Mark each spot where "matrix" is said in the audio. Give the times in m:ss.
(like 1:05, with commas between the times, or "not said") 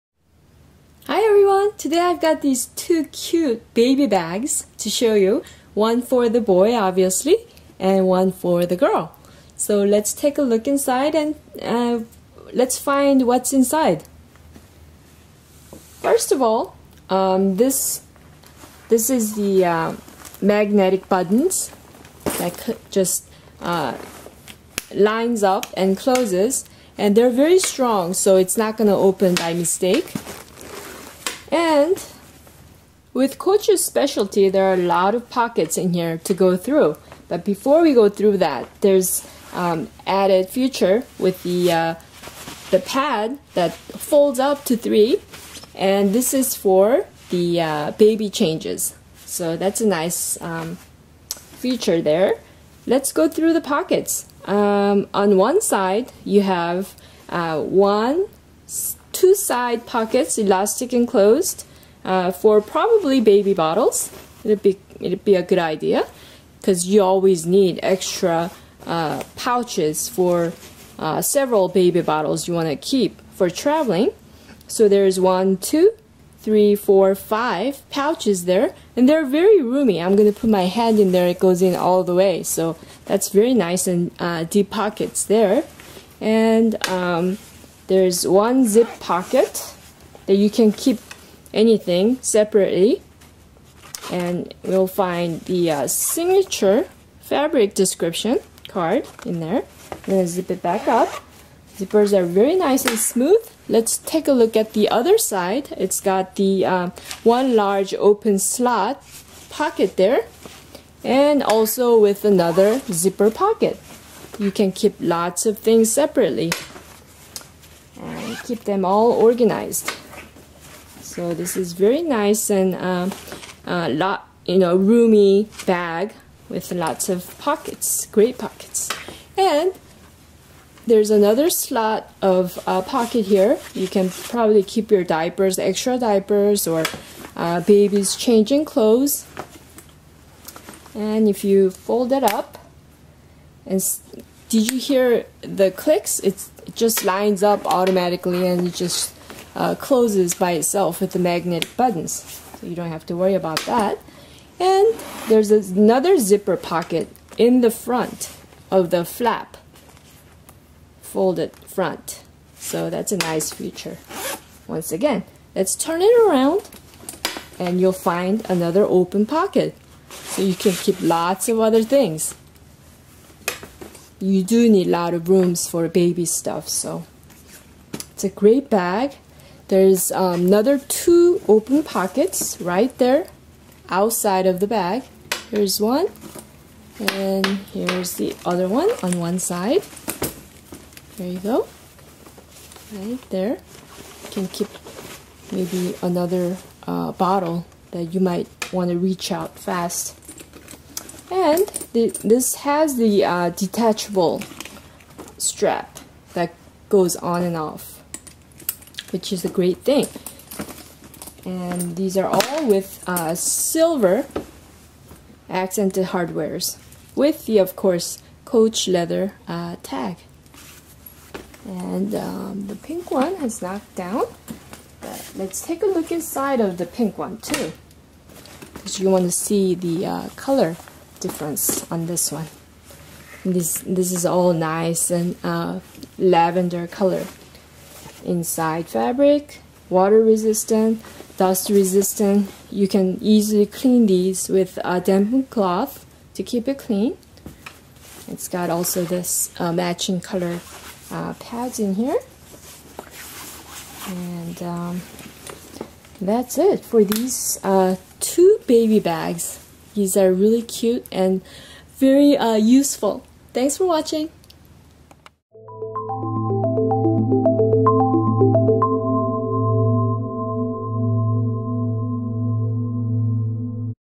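not said.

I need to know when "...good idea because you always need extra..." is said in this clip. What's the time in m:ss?
1:05.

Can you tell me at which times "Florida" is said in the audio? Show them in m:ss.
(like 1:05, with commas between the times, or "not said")
not said.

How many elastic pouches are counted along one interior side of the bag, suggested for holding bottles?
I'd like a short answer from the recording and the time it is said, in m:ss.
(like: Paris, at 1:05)
5, at 1:17.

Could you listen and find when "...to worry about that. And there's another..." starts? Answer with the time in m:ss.
2:33.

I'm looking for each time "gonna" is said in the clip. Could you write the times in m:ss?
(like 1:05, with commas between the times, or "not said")
1:20, 1:40.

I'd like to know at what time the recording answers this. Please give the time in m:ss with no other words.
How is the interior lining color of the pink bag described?
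3:56.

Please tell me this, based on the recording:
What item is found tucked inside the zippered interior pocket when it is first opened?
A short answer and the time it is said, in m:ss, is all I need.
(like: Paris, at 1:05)
signature fabric description card, at 1:35.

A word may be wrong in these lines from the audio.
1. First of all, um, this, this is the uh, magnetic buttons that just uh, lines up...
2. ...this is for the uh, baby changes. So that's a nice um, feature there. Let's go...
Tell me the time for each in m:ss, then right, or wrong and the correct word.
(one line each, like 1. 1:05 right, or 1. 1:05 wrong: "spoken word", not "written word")
1. 0:16 right
2. 0:46 right.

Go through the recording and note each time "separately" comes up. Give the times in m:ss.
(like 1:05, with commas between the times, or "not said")
1:32, 1:55.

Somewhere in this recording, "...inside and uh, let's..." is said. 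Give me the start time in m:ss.
0:10.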